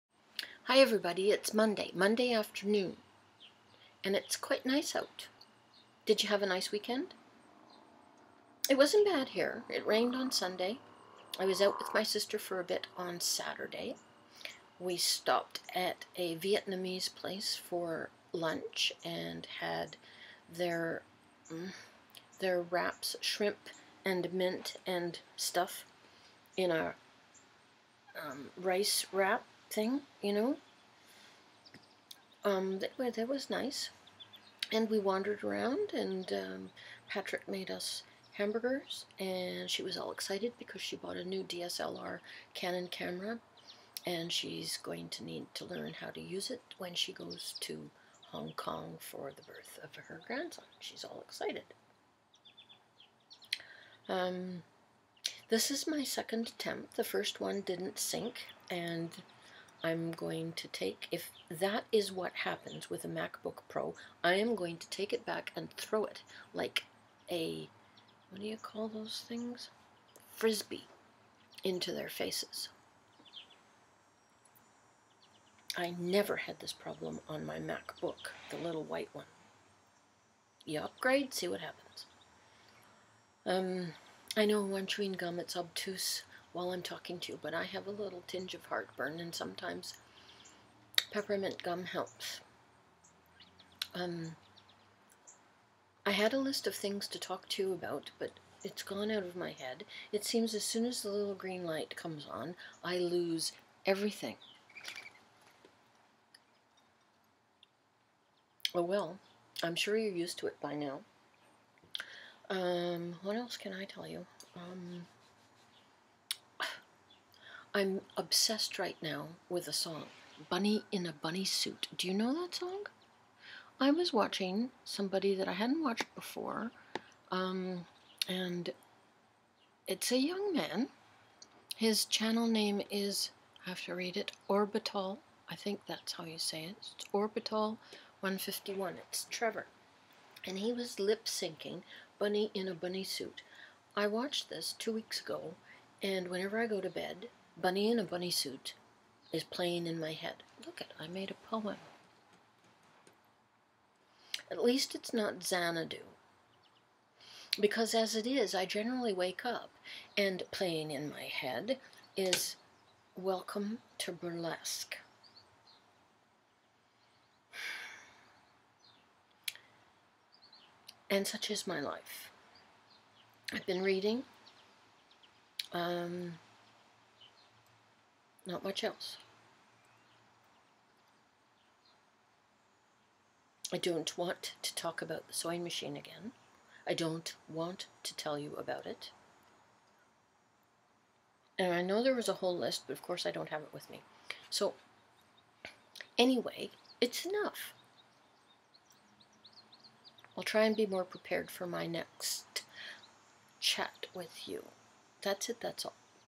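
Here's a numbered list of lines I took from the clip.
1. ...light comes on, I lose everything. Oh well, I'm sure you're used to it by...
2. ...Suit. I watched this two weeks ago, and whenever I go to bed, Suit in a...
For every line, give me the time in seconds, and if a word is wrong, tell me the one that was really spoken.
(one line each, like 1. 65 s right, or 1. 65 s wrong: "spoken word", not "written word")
1. 101 s right
2. 143 s wrong: "Bunny", not "Suit".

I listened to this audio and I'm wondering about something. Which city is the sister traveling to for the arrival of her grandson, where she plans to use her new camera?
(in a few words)
Hong Kong.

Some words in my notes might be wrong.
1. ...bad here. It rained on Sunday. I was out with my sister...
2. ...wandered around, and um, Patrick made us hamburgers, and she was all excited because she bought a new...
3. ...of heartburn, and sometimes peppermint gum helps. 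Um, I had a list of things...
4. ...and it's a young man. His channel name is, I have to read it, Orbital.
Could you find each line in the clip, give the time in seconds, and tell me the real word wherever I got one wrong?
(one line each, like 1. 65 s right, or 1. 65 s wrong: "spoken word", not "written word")
1. 9 s right
2. 34 s right
3. 88 s right
4. 128 s right.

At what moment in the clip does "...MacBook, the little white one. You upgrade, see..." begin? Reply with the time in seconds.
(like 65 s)
77 s.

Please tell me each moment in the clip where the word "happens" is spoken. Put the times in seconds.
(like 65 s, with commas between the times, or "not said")
62 s, 81 s.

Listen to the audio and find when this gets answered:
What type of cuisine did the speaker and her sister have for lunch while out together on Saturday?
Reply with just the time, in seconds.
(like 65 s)
16 s.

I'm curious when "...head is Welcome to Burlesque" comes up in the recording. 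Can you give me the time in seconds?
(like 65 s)
161 s.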